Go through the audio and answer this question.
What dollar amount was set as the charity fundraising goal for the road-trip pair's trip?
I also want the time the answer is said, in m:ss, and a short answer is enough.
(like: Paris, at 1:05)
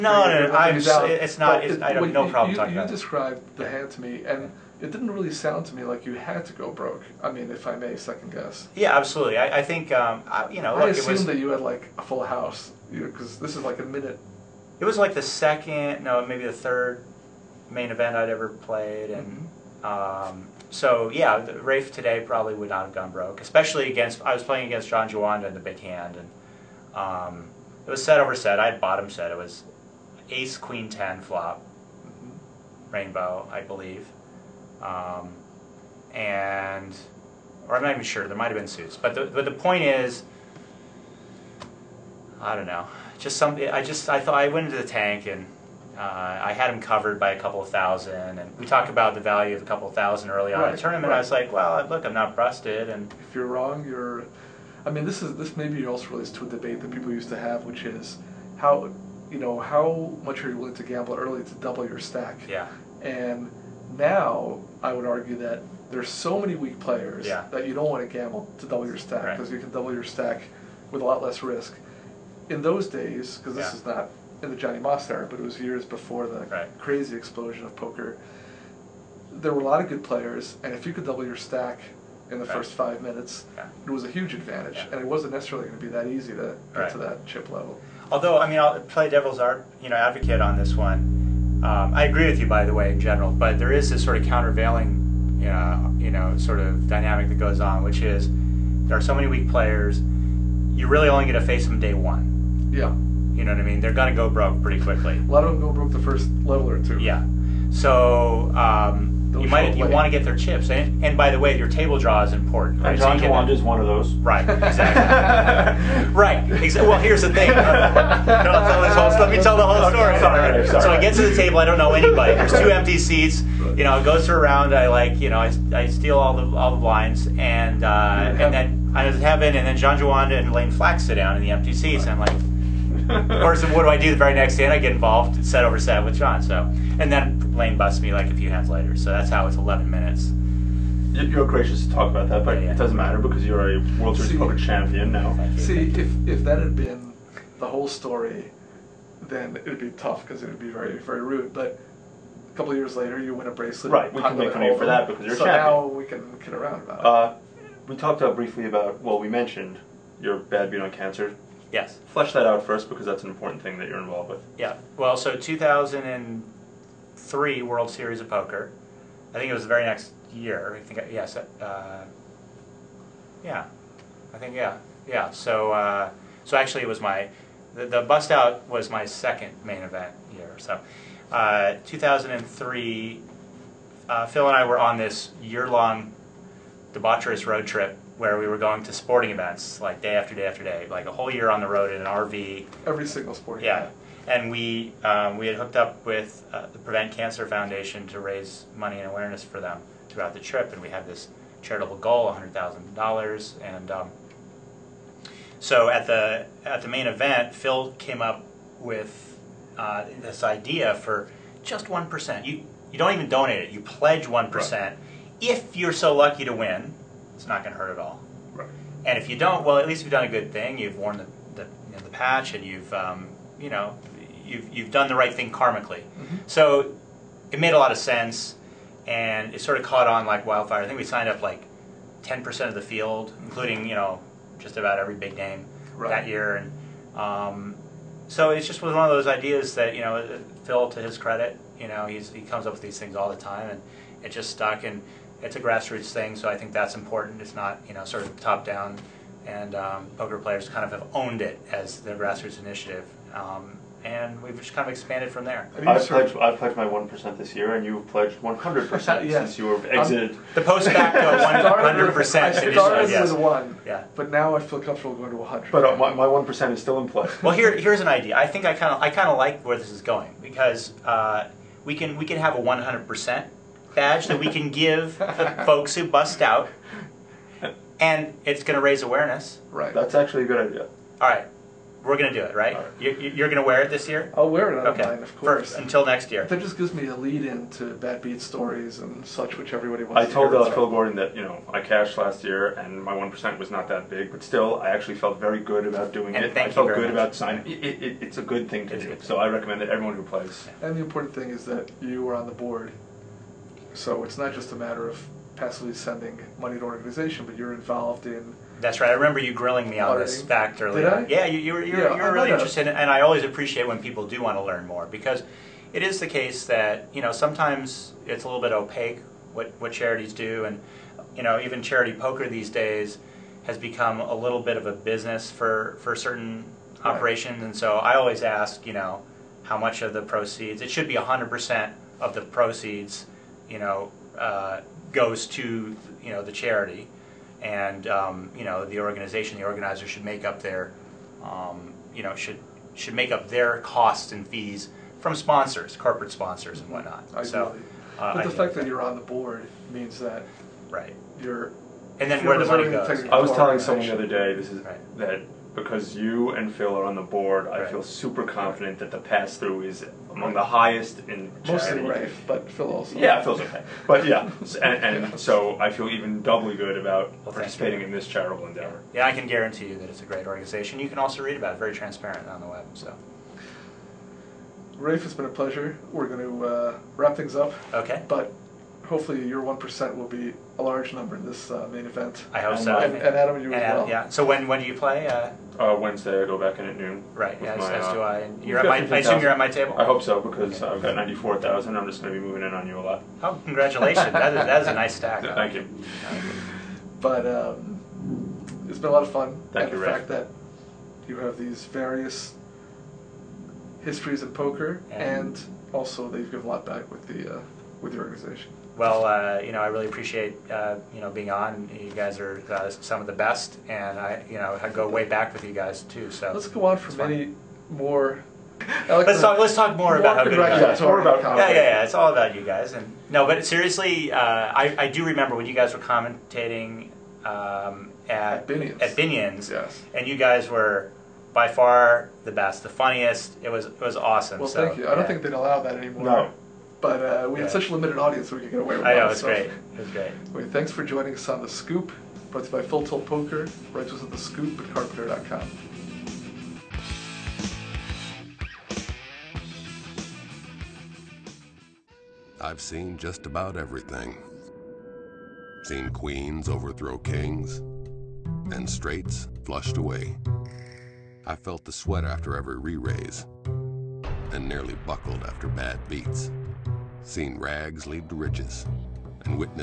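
$100,000, at 3:22.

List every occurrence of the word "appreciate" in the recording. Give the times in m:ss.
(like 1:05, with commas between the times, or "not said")
5:13, 6:50.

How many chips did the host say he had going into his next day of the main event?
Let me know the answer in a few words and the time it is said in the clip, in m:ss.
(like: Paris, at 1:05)
94,000, at 6:31.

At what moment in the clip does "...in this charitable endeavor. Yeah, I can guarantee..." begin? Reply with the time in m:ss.
6:08.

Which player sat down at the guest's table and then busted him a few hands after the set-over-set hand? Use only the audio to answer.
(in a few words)
Layne Flack.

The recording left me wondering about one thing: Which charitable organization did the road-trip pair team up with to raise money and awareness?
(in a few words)
Prevent Cancer Foundation.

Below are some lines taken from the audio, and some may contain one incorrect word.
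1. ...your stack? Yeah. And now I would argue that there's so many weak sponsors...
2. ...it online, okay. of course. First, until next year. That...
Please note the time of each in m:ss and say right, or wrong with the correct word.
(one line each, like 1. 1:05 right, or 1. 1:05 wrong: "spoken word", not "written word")
1. 1:01 wrong: "players", not "sponsors"
2. 4:44 right.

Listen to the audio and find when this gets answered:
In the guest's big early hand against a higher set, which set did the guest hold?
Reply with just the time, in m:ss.
0:28.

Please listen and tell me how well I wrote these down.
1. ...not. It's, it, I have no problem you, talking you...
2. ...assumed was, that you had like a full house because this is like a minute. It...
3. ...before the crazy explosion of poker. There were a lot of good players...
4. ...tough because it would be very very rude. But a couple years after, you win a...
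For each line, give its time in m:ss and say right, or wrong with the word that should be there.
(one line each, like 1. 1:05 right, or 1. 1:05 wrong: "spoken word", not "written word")
1. 0:01 right
2. 0:10 right
3. 1:15 right
4. 2:29 wrong: "later", not "after".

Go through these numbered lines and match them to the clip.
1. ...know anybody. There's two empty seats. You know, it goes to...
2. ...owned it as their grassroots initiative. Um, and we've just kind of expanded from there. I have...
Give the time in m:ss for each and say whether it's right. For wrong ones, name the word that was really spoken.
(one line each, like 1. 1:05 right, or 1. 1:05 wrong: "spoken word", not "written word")
1. 2:01 right
2. 4:11 right.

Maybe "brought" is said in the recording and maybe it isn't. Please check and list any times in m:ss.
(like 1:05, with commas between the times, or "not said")
7:22.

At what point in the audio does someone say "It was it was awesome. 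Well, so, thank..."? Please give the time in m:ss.
7:13.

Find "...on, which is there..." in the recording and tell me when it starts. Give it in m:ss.
1:37.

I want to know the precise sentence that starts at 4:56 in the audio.
Thank I felt you very good much.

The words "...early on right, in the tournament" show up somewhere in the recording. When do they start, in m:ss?
0:50.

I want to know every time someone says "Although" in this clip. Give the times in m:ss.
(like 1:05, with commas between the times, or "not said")
1:28.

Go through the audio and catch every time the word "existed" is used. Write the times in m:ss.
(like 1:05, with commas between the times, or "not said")
not said.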